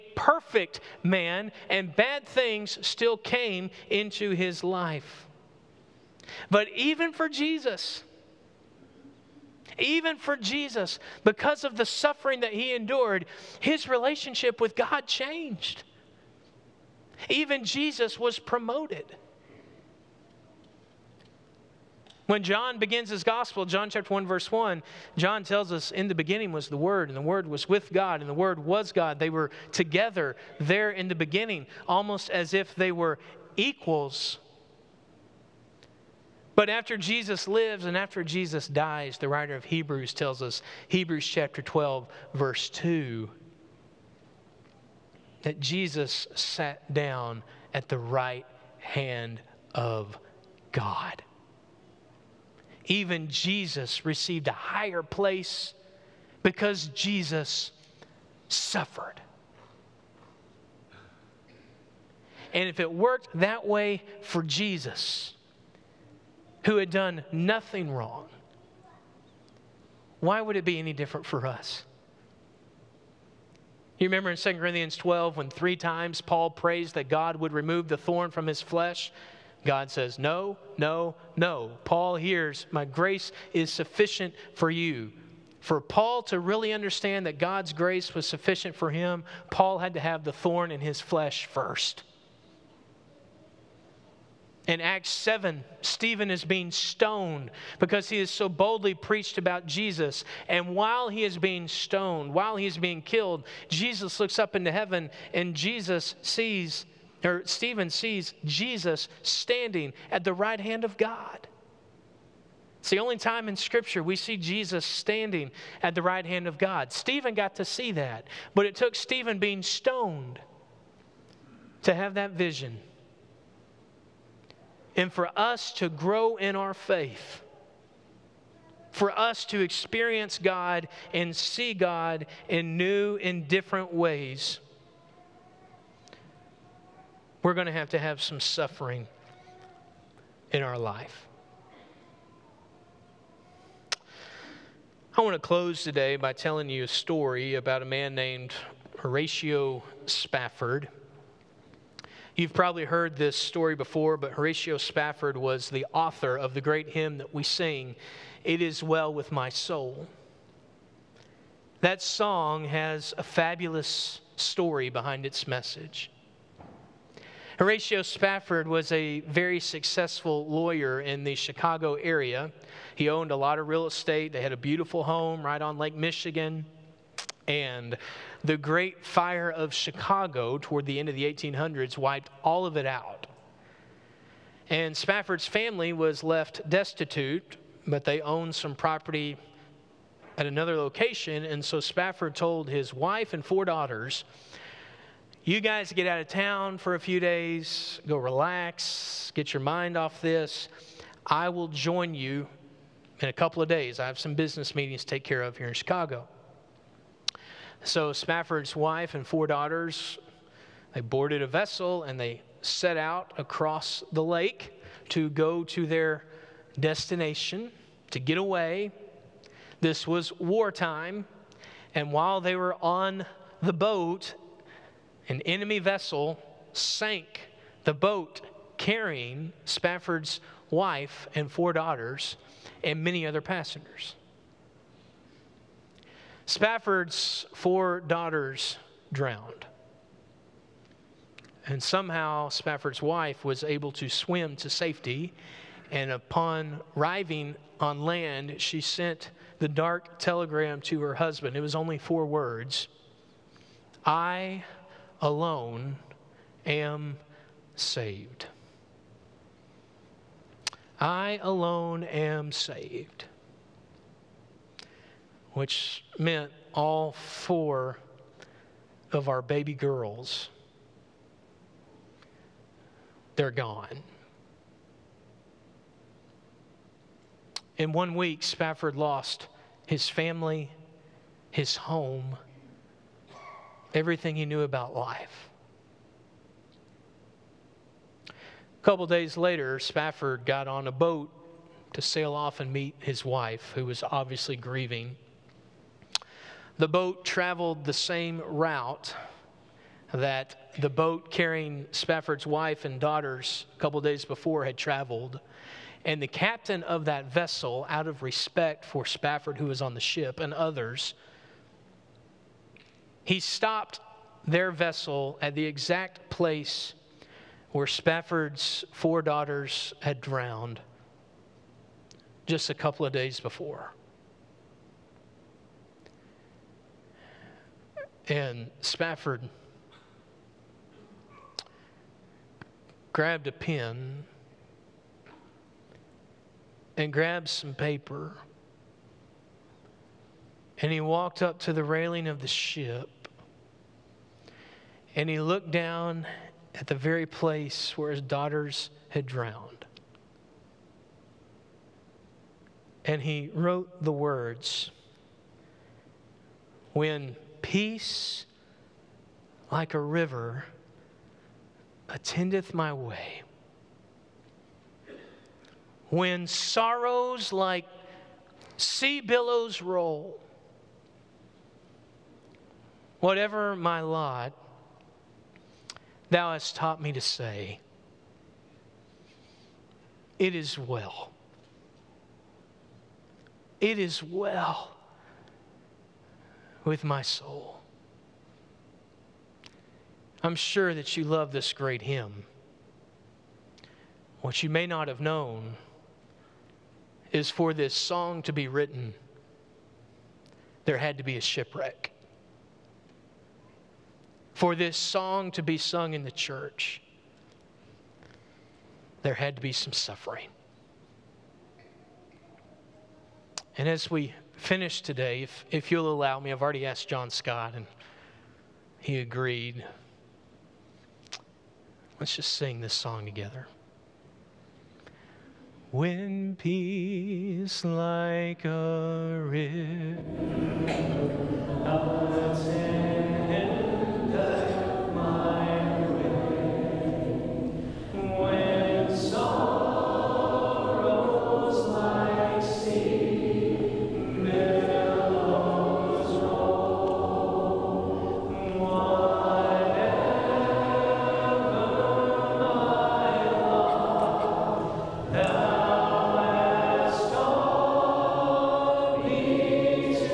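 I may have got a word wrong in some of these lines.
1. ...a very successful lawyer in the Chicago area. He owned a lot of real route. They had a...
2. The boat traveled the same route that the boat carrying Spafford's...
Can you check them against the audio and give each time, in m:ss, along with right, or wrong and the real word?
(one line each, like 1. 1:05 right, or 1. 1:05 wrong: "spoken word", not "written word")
1. 2:48 wrong: "estate", not "route"
2. 4:56 right.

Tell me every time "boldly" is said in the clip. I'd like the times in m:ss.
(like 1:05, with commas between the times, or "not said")
1:38.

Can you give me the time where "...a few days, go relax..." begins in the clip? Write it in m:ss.
3:16.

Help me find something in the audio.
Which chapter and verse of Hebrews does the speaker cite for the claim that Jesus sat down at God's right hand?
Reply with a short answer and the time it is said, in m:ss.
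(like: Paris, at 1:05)
Hebrews 12:2, at 0:40.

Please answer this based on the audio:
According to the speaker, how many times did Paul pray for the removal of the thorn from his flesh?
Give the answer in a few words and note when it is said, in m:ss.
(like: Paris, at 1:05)
3, at 1:15.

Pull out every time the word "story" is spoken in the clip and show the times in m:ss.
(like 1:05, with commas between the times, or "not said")
2:26, 2:33, 2:44.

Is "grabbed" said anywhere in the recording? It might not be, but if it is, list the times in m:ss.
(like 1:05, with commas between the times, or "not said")
5:33, 5:37.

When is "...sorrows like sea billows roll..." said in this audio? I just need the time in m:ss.
6:06.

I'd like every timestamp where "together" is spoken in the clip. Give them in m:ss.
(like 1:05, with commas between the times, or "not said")
0:29, 7:03.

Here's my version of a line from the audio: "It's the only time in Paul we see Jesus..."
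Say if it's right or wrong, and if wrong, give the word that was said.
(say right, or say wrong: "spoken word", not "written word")
wrong: "Scripture", not "Paul".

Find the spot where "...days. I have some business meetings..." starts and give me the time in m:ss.
3:23.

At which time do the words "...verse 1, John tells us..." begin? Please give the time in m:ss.
0:24.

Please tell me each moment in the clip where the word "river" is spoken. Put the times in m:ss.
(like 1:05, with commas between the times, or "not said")
5:59, 7:09.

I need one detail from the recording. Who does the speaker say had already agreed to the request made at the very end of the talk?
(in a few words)
John Scott.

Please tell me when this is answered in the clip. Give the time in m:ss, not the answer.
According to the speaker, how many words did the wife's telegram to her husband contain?
4:11.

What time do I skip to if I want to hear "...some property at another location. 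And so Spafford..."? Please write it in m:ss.
3:08.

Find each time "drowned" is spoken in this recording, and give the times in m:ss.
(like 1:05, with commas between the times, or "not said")
3:59, 5:20, 5:49.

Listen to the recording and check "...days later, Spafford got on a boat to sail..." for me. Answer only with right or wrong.
right.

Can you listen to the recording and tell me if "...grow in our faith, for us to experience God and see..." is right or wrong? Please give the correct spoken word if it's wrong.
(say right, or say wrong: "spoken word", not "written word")
right.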